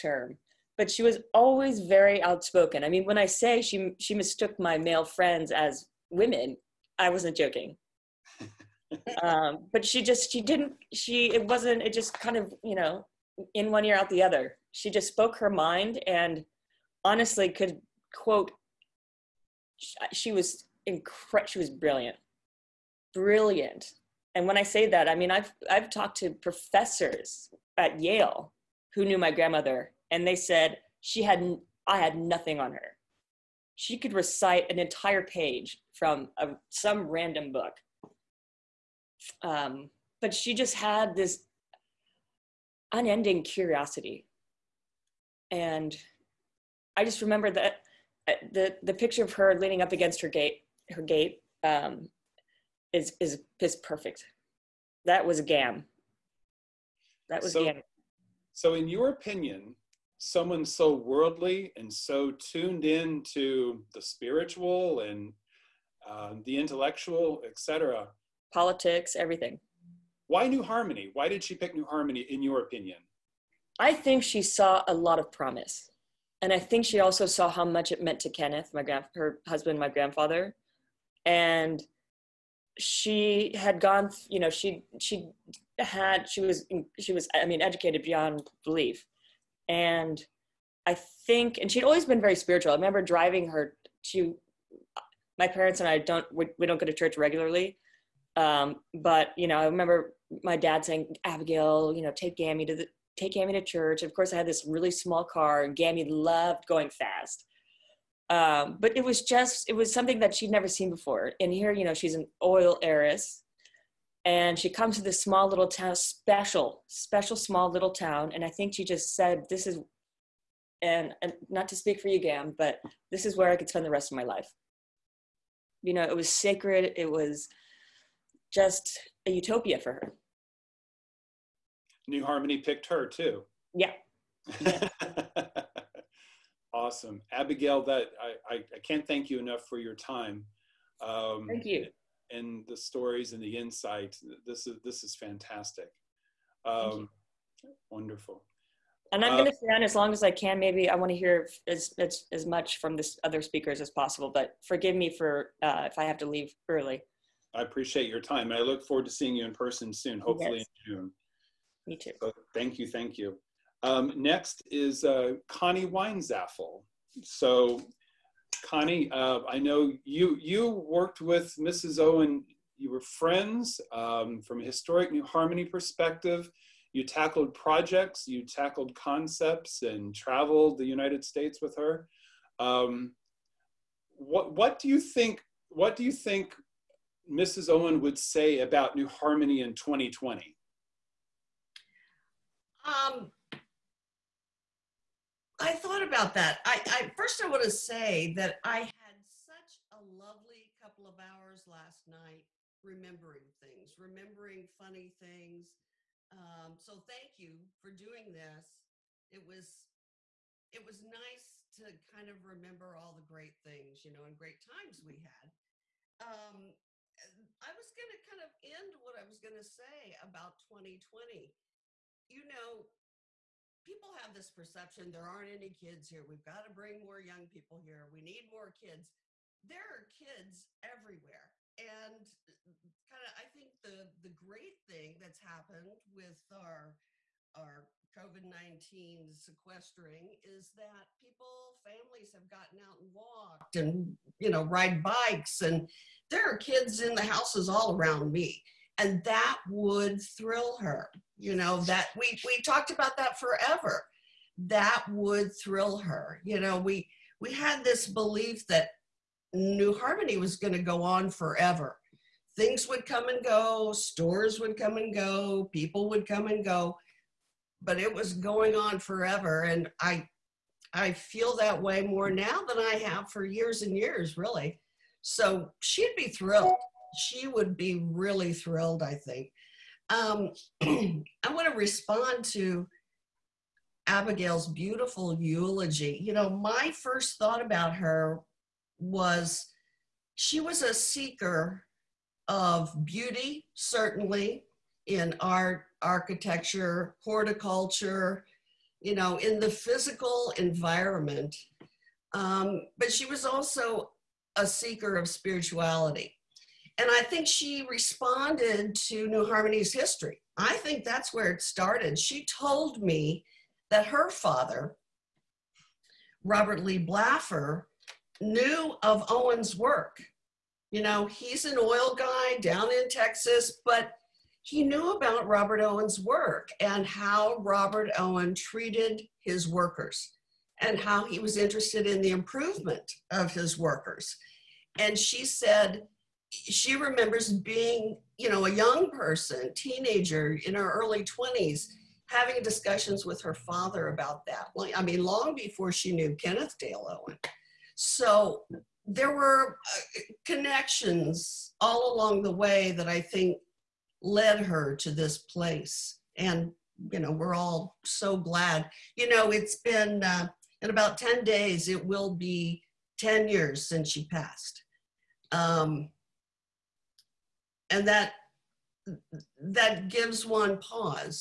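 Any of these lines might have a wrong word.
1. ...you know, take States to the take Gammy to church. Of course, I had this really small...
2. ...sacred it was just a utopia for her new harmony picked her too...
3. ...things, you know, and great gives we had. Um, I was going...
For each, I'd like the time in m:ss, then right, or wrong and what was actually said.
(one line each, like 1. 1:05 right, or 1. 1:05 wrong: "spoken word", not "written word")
1. 1:41 wrong: "Gammy", not "States"
2. 2:06 right
3. 3:33 wrong: "times", not "gives".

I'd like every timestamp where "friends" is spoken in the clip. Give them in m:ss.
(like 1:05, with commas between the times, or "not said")
0:05, 2:53.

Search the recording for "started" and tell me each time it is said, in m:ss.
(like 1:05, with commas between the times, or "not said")
5:11.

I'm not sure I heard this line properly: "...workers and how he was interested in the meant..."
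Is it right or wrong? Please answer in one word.
wrong.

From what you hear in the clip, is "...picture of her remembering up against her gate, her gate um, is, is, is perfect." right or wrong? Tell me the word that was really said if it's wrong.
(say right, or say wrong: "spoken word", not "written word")
wrong: "leaning", not "remembering".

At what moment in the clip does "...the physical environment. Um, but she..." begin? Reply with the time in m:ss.
4:59.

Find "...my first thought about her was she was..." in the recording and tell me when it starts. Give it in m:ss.
4:46.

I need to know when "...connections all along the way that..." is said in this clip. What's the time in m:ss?
5:50.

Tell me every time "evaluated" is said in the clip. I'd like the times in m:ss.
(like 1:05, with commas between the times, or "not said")
not said.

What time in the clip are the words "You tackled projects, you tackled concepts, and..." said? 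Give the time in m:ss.
2:56.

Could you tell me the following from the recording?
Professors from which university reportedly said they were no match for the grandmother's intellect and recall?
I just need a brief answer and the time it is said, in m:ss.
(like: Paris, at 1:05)
Yale, at 0:27.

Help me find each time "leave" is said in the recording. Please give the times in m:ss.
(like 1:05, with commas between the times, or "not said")
2:36.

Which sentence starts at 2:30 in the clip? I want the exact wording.
Maybe I want to hear as, as as much from this other speakers as possible.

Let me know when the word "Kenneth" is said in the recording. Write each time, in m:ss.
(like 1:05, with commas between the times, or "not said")
1:18, 5:46.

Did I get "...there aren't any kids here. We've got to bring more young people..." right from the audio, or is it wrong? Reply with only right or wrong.
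right.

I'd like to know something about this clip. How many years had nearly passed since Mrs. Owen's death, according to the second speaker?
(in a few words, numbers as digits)
10.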